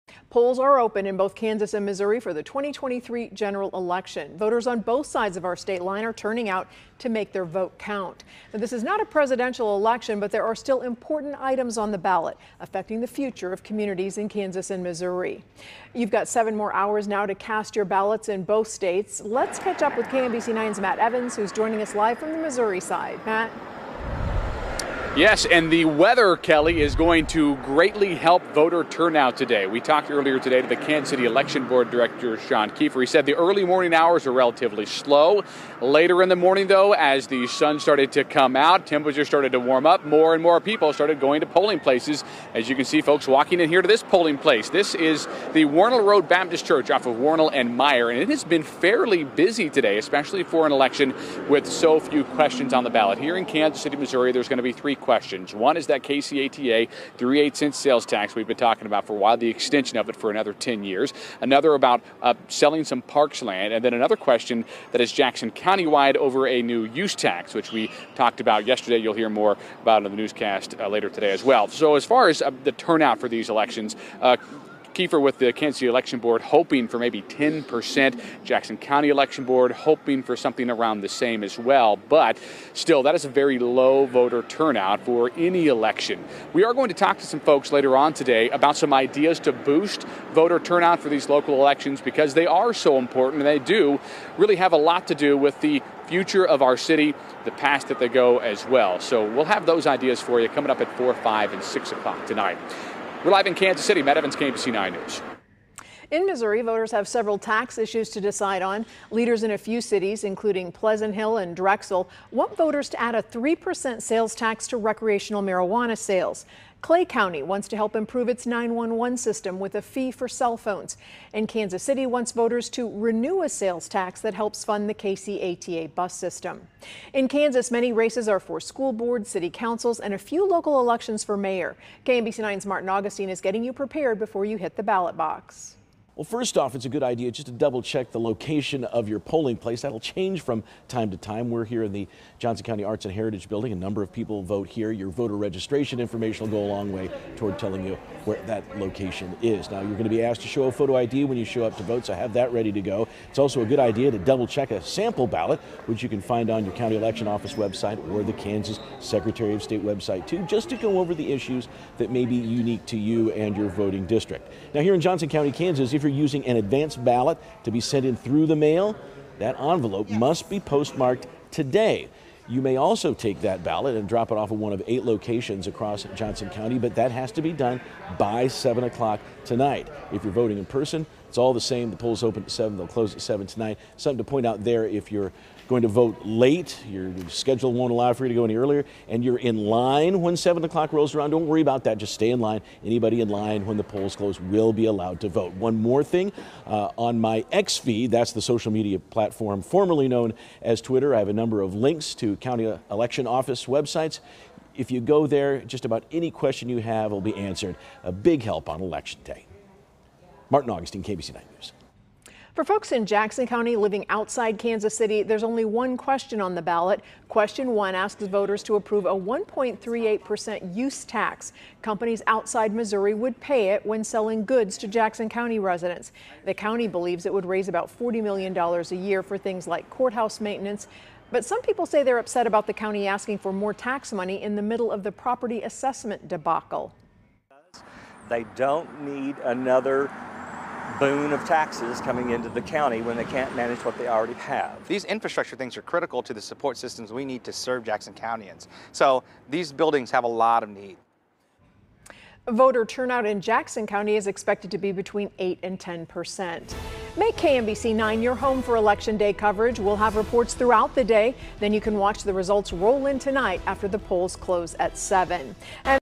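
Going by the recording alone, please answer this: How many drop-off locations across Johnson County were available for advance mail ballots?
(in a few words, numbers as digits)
8.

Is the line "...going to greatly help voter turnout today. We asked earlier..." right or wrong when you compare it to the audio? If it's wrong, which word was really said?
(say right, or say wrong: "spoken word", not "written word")
wrong: "talked", not "asked".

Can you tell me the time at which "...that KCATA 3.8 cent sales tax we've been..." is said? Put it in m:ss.
0:55.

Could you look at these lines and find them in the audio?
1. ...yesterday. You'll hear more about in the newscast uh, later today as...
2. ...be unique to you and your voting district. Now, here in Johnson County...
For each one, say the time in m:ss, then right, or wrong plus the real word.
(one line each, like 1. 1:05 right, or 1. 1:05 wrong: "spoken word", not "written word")
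1. 1:08 right
2. 2:42 right.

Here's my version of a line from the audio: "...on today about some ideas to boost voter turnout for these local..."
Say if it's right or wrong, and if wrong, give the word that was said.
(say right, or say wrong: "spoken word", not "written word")
right.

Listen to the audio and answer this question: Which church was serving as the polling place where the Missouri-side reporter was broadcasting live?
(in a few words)
Wornall Road Baptist Church.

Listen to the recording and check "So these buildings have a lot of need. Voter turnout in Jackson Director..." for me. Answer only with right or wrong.
wrong.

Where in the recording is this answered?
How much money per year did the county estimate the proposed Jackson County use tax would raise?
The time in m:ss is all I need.
3:47.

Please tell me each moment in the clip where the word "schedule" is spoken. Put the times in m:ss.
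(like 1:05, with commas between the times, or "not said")
3:07.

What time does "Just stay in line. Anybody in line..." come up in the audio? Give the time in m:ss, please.
3:11.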